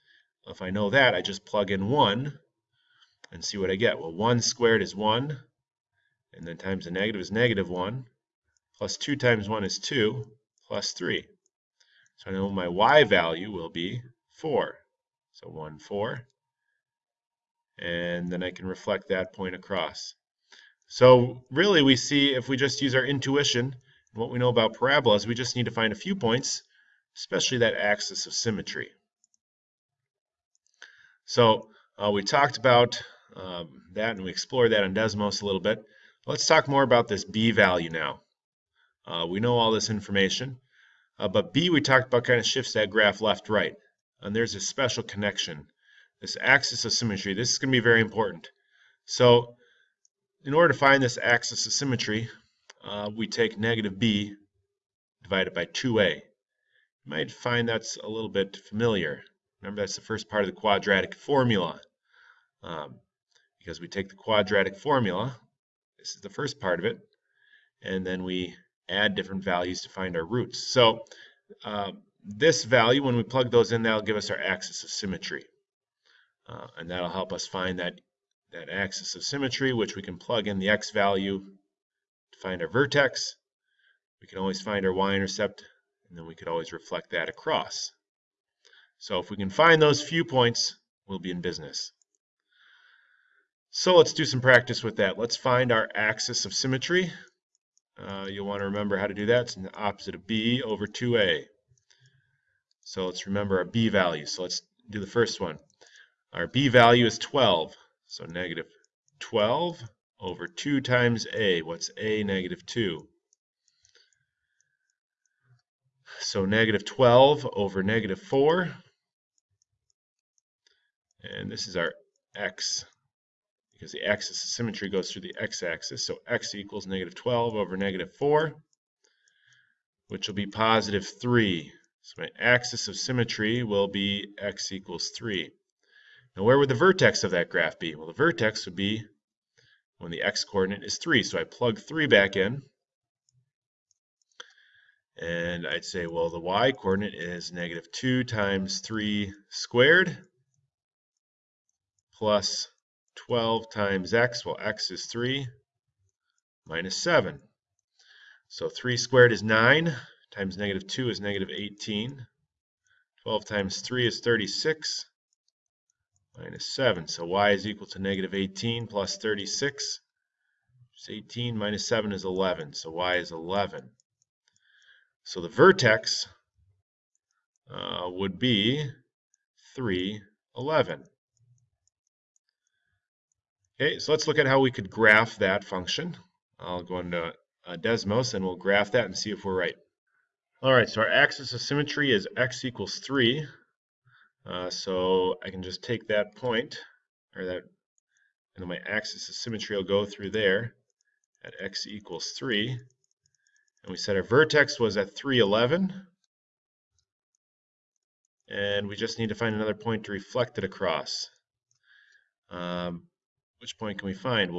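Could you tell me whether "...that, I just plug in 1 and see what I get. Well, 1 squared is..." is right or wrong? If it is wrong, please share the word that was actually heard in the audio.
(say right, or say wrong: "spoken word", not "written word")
right.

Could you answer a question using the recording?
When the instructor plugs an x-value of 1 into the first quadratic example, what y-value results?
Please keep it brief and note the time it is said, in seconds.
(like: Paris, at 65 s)
4, at 12 s.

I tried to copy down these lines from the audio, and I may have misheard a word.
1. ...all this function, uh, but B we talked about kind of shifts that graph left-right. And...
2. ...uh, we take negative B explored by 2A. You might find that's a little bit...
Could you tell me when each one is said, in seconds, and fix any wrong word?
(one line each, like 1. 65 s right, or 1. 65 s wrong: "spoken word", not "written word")
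1. 39 s wrong: "information", not "function"
2. 52 s wrong: "divided", not "explored".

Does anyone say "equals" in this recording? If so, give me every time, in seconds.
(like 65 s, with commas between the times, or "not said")
126 s, 134 s, 167 s, 192 s, 201 s.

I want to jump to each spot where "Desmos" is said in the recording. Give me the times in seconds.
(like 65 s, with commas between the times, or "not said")
34 s, 187 s.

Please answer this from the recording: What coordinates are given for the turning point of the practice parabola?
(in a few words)
(3, 11).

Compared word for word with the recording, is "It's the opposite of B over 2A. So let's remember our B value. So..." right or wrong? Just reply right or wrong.
right.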